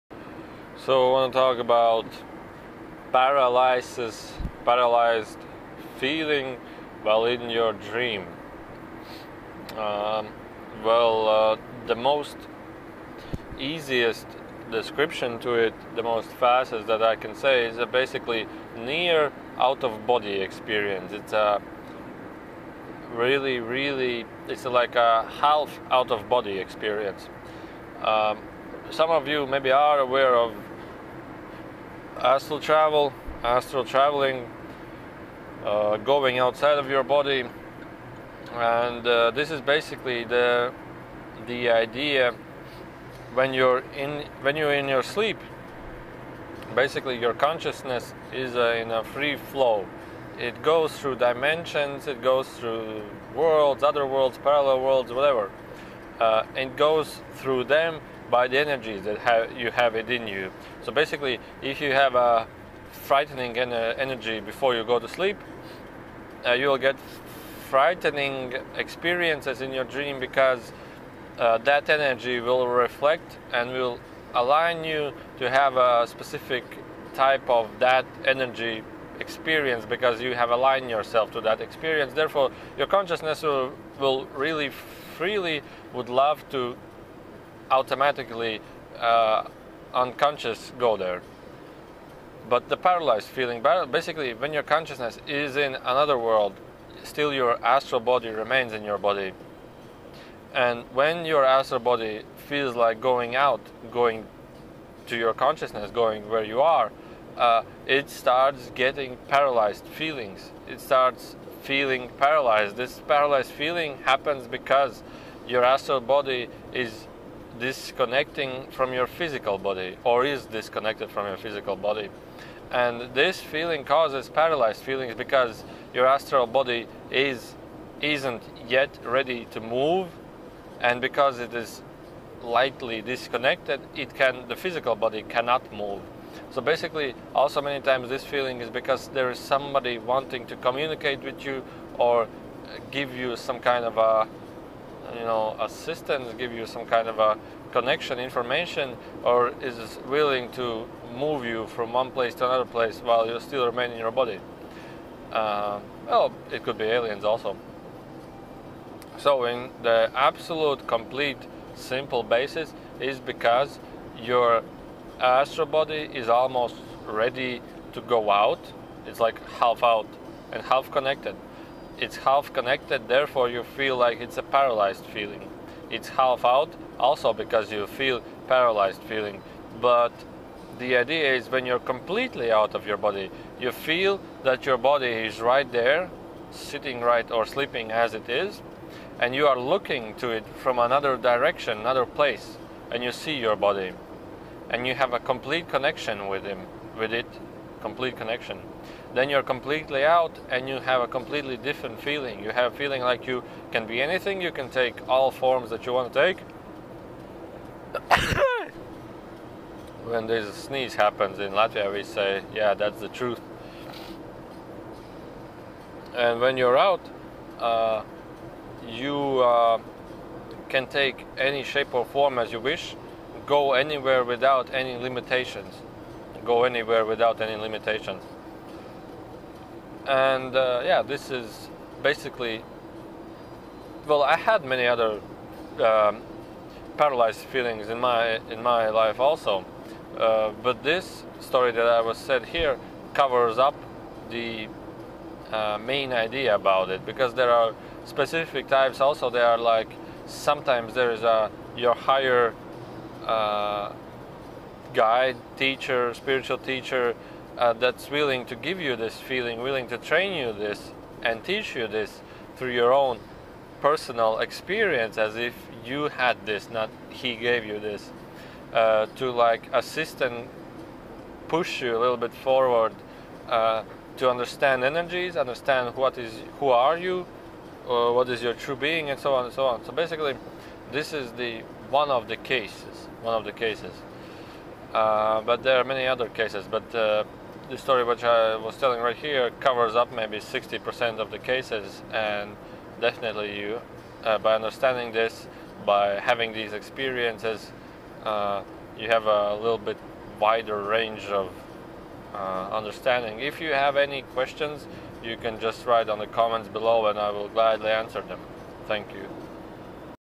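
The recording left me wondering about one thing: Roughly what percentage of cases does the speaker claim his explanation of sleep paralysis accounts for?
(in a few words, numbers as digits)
60%.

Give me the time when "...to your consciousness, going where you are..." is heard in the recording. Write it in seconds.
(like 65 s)
105 s.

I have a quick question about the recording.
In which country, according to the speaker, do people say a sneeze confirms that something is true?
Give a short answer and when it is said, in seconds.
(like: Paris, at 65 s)
Latvia, at 211 s.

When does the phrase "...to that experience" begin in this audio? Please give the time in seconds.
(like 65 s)
81 s.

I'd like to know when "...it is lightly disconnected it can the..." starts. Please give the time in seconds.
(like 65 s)
131 s.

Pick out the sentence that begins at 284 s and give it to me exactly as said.
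Uh, but there are many other cases.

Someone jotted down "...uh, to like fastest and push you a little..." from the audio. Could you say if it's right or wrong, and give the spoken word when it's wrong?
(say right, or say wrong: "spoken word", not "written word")
wrong: "assist", not "fastest".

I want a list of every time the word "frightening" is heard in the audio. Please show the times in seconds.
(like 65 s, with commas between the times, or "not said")
62 s, 67 s.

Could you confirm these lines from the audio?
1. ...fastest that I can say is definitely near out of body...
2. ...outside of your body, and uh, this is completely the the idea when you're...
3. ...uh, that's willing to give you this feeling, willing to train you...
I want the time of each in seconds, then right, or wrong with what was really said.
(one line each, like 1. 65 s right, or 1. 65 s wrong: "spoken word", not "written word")
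1. 16 s wrong: "basically", not "definitely"
2. 36 s wrong: "basically", not "completely"
3. 257 s right.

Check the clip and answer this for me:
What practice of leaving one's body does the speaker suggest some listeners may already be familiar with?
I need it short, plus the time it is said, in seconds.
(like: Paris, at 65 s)
astral travel, at 32 s.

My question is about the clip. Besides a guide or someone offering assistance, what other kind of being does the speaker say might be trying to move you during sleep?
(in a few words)
aliens.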